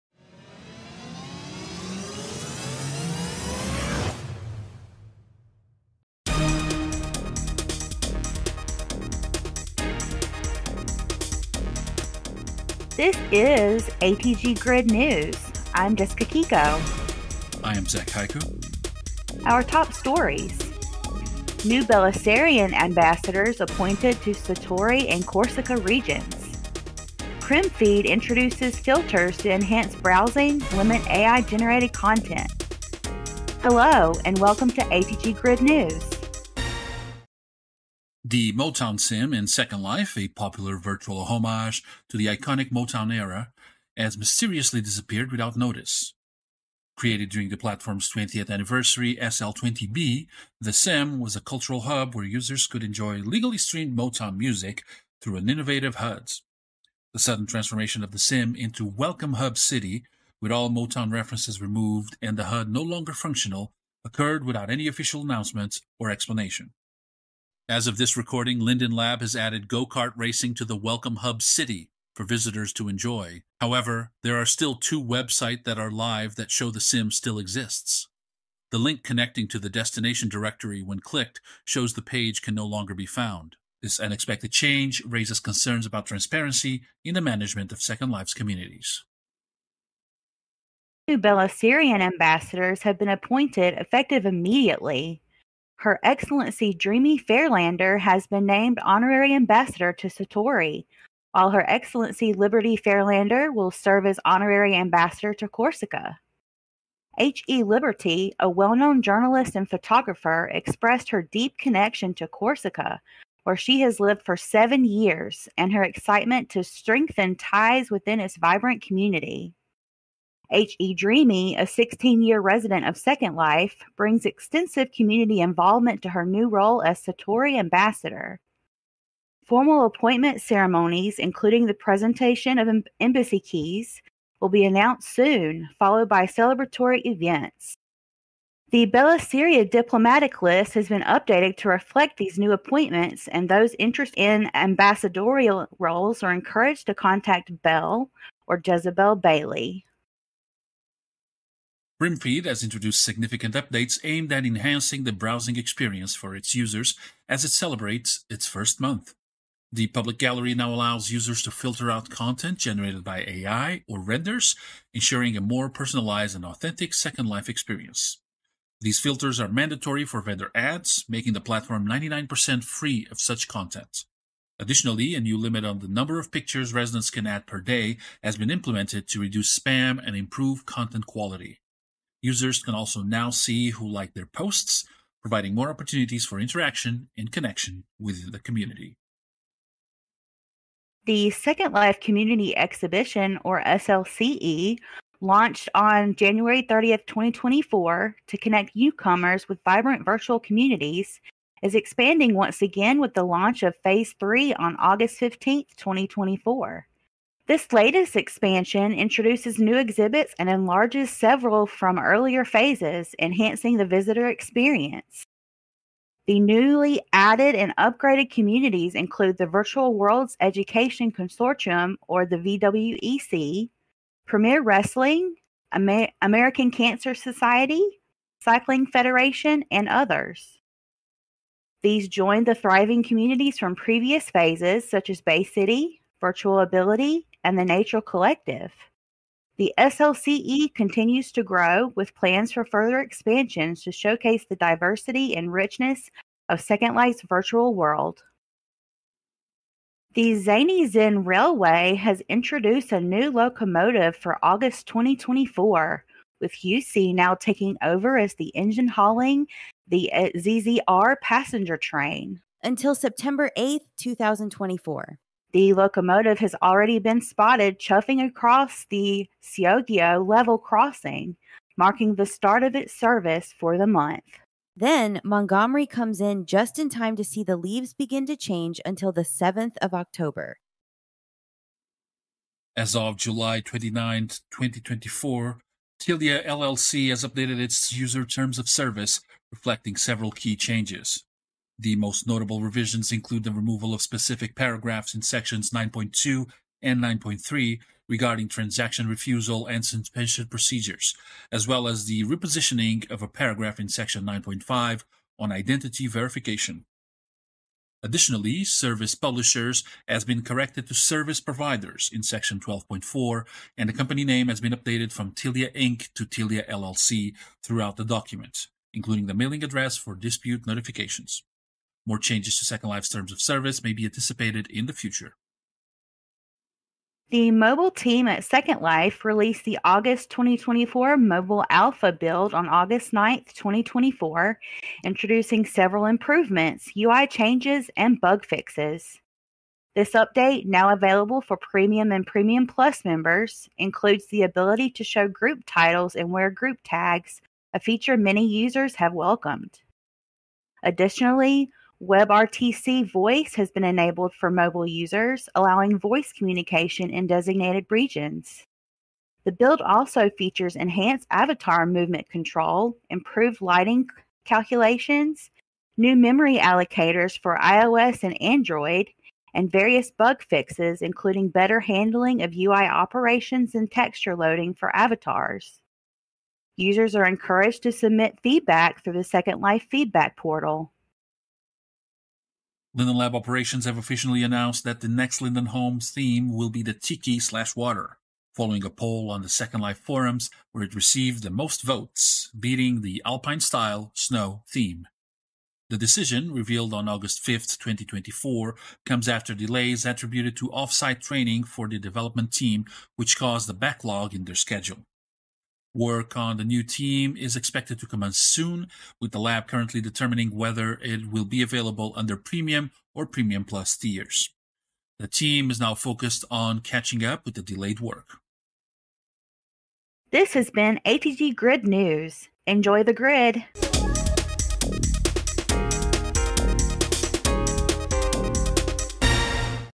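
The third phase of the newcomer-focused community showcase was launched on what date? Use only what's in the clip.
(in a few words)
August 15th, 2024.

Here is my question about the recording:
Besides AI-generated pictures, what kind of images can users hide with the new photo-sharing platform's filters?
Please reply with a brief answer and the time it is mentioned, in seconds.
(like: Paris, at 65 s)
Renders, at 163 s.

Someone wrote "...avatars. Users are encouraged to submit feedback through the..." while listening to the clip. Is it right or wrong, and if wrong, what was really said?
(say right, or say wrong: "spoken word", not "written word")
right.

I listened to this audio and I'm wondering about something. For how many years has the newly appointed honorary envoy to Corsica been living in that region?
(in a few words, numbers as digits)
7.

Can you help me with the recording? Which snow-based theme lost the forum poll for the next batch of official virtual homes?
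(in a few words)
Alpine.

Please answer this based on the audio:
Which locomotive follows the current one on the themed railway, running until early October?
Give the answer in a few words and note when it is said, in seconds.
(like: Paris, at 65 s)
Montgomery, at 275 s.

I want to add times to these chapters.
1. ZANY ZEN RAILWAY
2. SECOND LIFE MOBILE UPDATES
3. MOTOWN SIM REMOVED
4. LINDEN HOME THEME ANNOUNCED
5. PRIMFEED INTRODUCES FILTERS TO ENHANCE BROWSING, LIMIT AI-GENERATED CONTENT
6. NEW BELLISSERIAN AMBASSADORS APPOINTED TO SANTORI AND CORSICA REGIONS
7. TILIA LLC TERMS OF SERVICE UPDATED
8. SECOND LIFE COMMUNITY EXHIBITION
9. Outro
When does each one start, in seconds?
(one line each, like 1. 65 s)
1. 249 s
2. 326 s
3. 37 s
4. 381 s
5. 150 s
6. 90 s
7. 281 s
8. 190 s
9. 419 s.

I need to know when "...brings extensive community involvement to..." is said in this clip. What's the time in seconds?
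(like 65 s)
123 s.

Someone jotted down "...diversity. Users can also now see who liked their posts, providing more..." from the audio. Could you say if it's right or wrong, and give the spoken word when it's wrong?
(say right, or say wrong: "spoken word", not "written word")
wrong: "quality", not "diversity".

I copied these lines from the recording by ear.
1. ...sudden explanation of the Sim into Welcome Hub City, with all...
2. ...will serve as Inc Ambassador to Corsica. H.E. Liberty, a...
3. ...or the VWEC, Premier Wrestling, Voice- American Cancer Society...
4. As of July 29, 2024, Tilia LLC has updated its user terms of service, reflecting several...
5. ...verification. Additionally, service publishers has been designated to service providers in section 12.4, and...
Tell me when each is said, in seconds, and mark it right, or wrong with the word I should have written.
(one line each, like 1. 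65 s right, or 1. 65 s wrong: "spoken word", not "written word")
1. 57 s wrong: "transformation", not "explanation"
2. 103 s wrong: "Honorary", not "Inc"
3. 222 s wrong: "Amer", not "Voice"
4. 282 s right
5. 306 s wrong: "corrected", not "designated".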